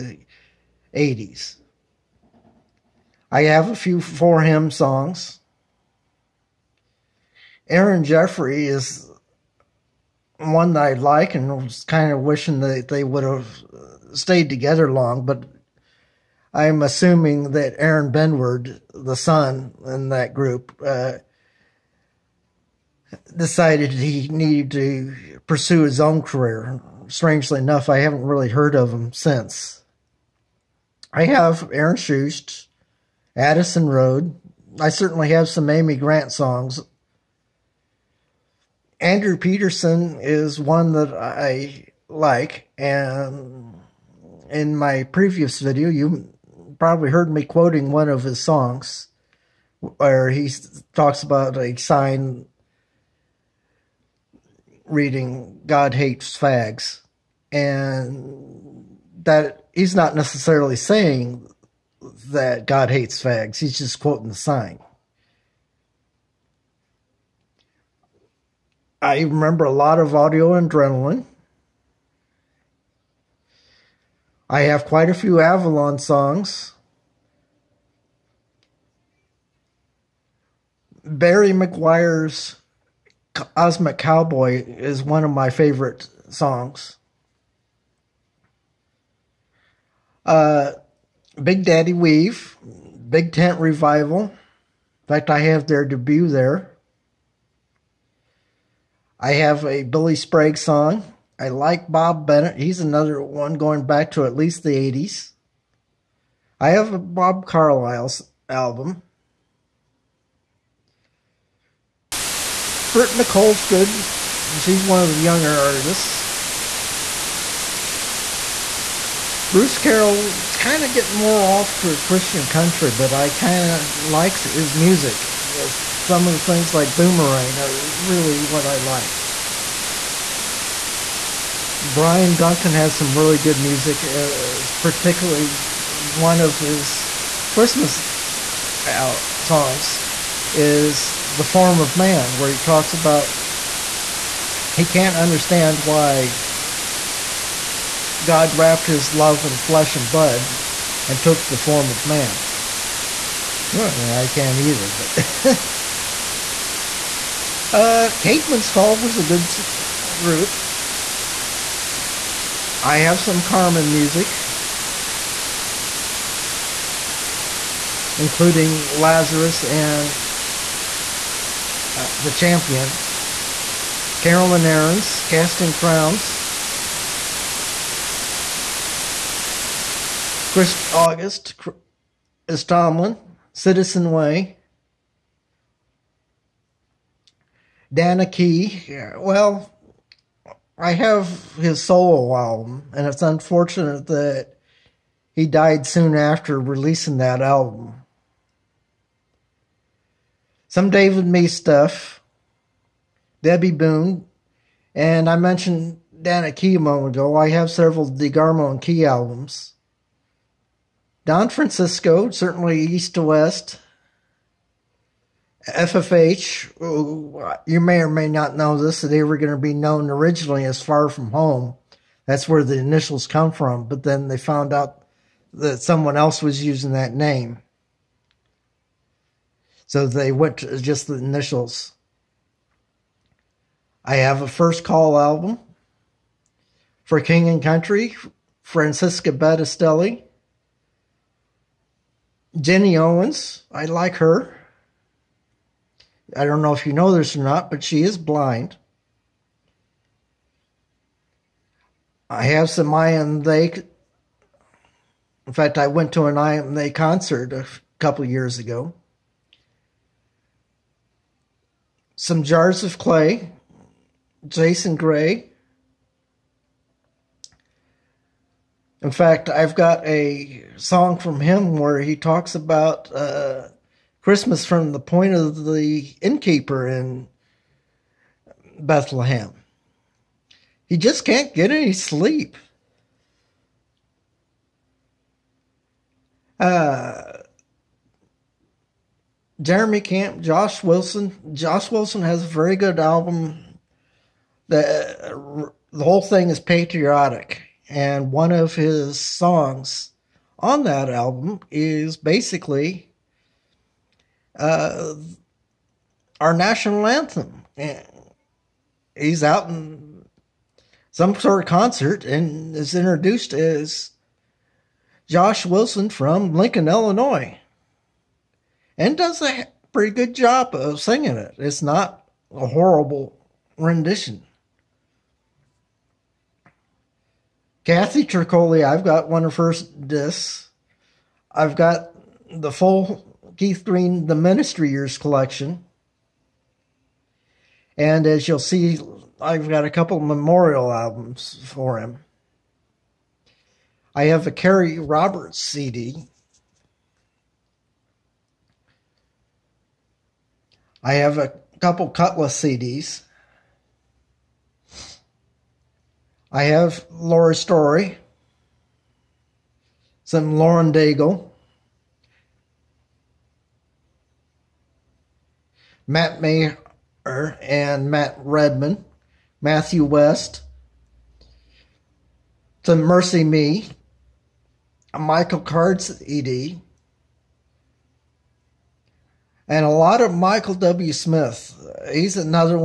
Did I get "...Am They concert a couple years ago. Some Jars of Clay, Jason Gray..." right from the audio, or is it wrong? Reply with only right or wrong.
right.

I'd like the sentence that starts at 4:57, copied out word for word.
And one of his songs on that album is basically uh, our national anthem.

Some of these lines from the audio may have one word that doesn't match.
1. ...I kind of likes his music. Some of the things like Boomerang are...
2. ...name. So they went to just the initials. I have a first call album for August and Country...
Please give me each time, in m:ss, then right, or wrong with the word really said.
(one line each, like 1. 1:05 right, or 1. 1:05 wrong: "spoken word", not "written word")
1. 2:03 right
2. 3:47 wrong: "King", not "August".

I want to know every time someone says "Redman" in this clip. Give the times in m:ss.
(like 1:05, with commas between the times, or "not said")
6:08.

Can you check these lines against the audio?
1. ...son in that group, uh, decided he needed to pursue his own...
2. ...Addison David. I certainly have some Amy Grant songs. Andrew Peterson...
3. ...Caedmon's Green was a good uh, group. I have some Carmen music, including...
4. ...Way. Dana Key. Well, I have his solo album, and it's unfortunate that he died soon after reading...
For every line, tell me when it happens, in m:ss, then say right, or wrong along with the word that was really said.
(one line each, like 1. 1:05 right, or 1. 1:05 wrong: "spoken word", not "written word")
1. 0:19 right
2. 0:33 wrong: "Road", not "David"
3. 2:38 wrong: "Call", not "Green"
4. 3:04 wrong: "releasing", not "reading".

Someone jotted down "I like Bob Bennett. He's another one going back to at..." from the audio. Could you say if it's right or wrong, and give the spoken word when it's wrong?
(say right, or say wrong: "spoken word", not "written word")
right.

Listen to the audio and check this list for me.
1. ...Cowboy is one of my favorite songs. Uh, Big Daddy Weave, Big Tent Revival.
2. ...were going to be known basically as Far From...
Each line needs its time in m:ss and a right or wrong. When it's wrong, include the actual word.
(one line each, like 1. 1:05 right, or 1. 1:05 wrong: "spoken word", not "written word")
1. 1:23 right
2. 3:39 wrong: "originally", not "basically".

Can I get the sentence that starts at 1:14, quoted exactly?
I have quite a few Avalon songs.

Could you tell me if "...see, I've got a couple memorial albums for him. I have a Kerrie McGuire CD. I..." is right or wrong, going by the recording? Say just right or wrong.
wrong.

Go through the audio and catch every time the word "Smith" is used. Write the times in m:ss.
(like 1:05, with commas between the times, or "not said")
6:21.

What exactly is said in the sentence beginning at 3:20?
Some David Meece stuff, Debby Boone, and I mentioned Dana Key a moment ago.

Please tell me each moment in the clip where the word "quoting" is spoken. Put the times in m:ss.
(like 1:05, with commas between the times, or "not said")
0:47, 1:03.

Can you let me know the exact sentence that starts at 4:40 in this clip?
He just can't get any sleep.